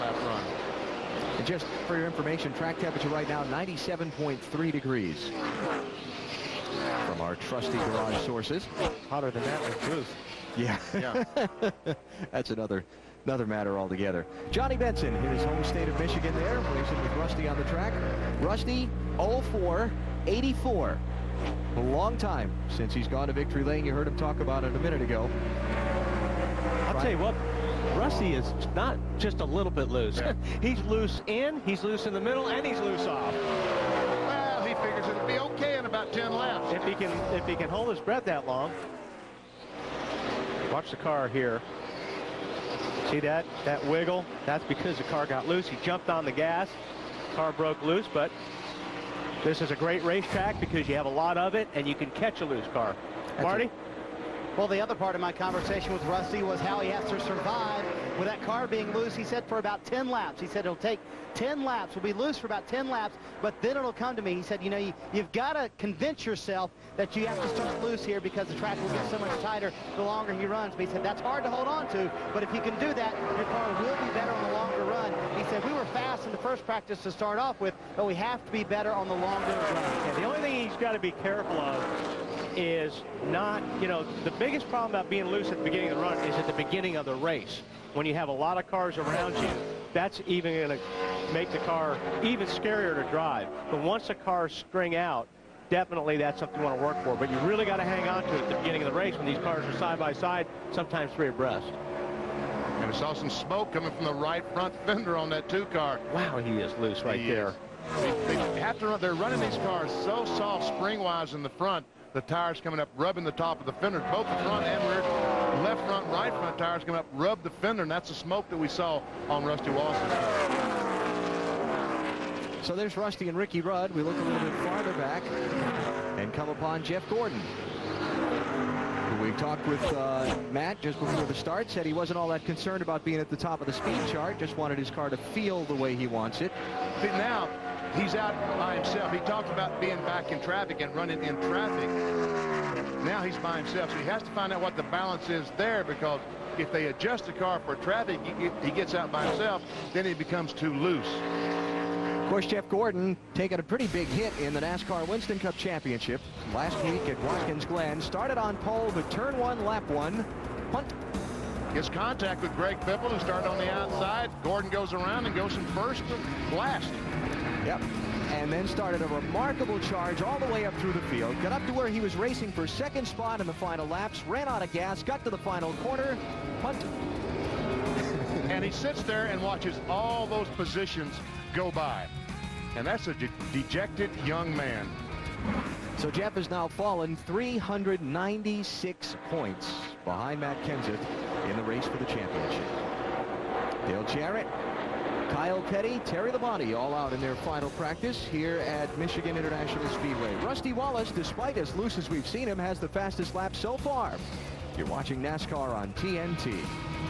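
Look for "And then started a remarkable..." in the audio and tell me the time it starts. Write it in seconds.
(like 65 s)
168 s.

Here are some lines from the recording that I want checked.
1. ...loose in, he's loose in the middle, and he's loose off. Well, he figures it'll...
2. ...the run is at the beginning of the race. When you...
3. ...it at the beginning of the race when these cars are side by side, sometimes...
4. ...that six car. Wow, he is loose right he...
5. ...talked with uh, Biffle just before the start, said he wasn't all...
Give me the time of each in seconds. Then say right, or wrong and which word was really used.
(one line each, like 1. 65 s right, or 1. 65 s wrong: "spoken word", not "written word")
1. 30 s right
2. 85 s right
3. 98 s right
4. 105 s wrong: "two", not "six"
5. 129 s wrong: "Matt", not "Biffle".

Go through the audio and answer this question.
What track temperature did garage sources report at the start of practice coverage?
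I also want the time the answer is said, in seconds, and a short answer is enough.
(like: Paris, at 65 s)
97.3 degrees, at 3 s.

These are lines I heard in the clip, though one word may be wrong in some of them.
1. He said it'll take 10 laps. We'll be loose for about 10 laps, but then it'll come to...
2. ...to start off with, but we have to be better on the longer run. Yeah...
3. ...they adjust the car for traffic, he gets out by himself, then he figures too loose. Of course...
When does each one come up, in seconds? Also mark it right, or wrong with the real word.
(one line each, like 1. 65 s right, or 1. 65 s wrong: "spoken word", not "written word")
1. 60 s right
2. 77 s right
3. 146 s wrong: "becomes", not "figures".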